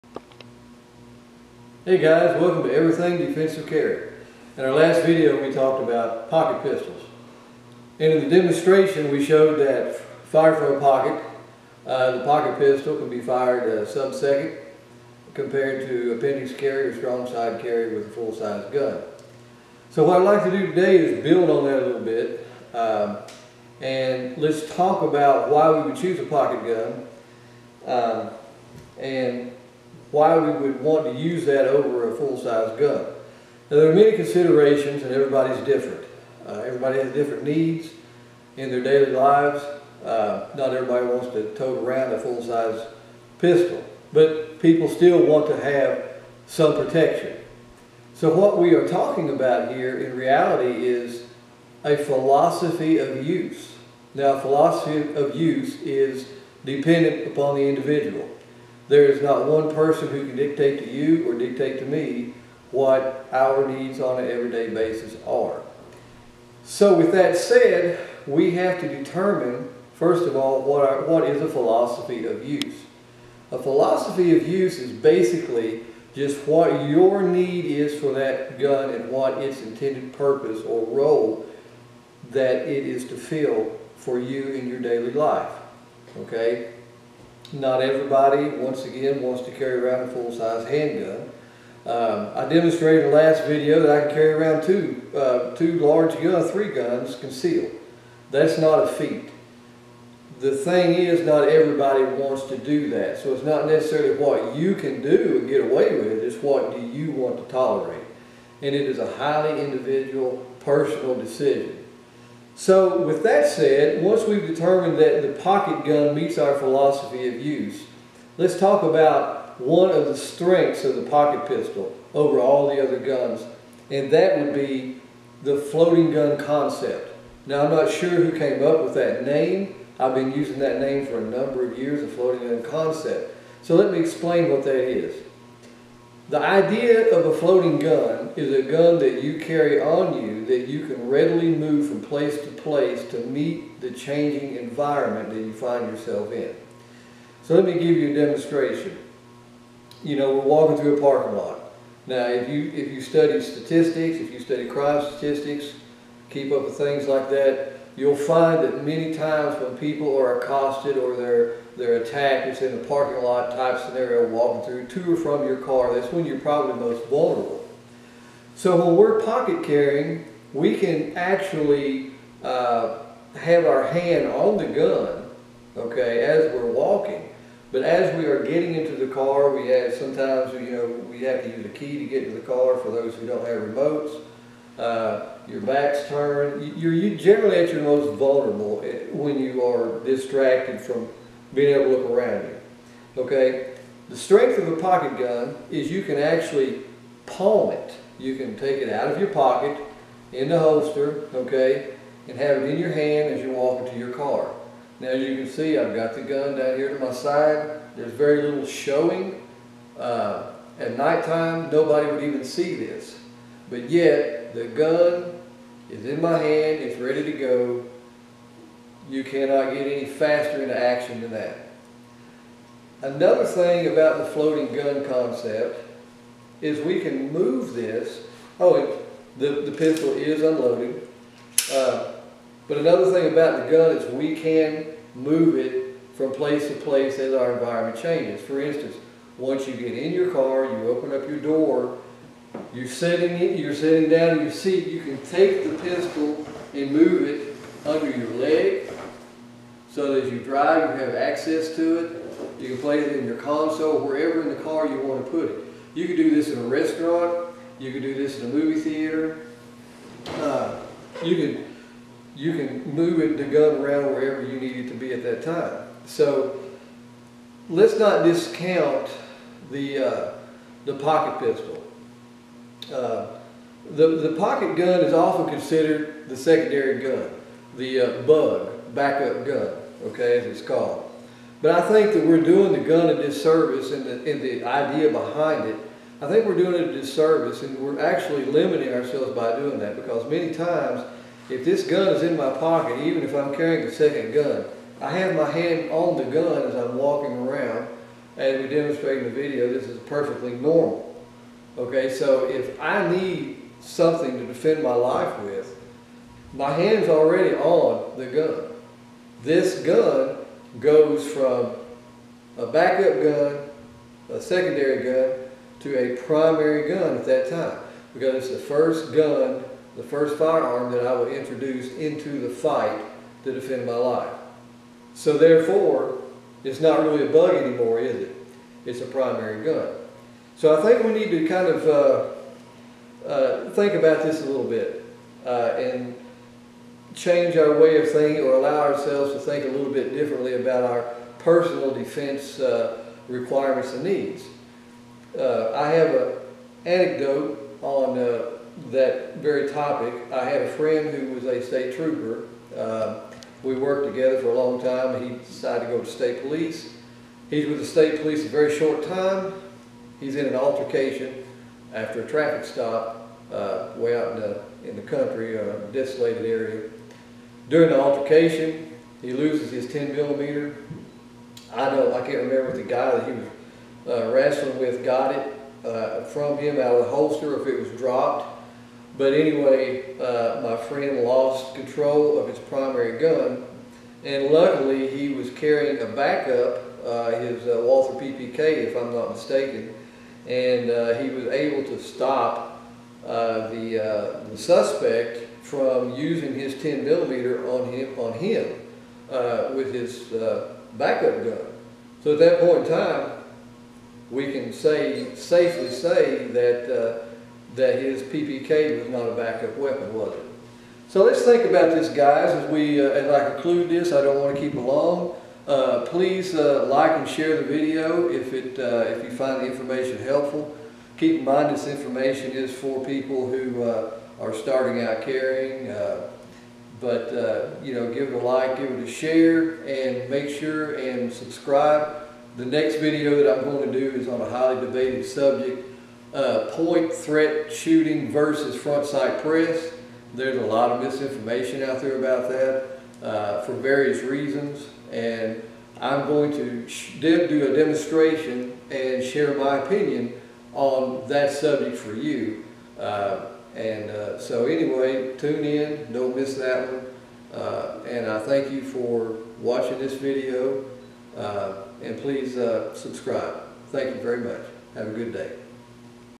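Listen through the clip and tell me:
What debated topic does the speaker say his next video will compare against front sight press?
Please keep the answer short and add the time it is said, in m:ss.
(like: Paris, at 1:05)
Point threat shooting, at 7:16.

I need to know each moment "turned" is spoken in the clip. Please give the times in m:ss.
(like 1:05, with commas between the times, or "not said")
3:06.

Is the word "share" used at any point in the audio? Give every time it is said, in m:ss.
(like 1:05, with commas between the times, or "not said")
6:57, 7:09, 7:29.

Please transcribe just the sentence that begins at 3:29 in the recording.
Uh, at nighttime, nobody would even see this.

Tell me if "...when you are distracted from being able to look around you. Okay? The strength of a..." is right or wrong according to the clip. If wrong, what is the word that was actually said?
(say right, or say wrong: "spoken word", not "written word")
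right.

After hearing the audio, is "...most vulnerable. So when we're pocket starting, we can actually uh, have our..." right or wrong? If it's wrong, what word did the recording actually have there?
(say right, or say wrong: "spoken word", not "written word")
wrong: "carrying", not "starting".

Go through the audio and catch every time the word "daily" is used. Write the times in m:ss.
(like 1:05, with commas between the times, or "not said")
0:38, 1:24.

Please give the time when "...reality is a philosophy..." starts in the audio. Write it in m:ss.
0:50.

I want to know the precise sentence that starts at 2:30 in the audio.
You know, we're walking through a parking lot.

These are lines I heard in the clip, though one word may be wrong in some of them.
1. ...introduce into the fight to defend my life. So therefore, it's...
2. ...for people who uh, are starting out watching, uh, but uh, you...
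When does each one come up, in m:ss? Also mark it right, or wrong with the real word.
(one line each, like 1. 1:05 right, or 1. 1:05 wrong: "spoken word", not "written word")
1. 5:21 right
2. 7:02 wrong: "carrying", not "watching".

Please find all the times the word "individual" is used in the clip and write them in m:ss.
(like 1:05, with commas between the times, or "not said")
0:57, 1:49.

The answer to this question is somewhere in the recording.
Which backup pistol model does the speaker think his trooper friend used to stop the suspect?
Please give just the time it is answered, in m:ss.
6:27.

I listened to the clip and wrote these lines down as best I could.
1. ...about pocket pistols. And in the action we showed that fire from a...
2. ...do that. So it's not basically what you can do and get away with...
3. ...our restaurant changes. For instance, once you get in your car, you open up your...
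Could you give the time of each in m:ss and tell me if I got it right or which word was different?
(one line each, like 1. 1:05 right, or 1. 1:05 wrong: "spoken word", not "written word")
1. 0:05 wrong: "demonstration", not "action"
2. 1:42 wrong: "necessarily", not "basically"
3. 3:57 wrong: "environment", not "restaurant".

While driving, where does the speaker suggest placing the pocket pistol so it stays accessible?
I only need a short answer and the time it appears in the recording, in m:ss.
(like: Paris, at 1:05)
Under your leg, at 4:07.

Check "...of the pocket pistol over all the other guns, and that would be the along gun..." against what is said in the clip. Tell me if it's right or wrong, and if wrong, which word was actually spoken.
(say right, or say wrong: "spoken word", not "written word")
wrong: "floating", not "along".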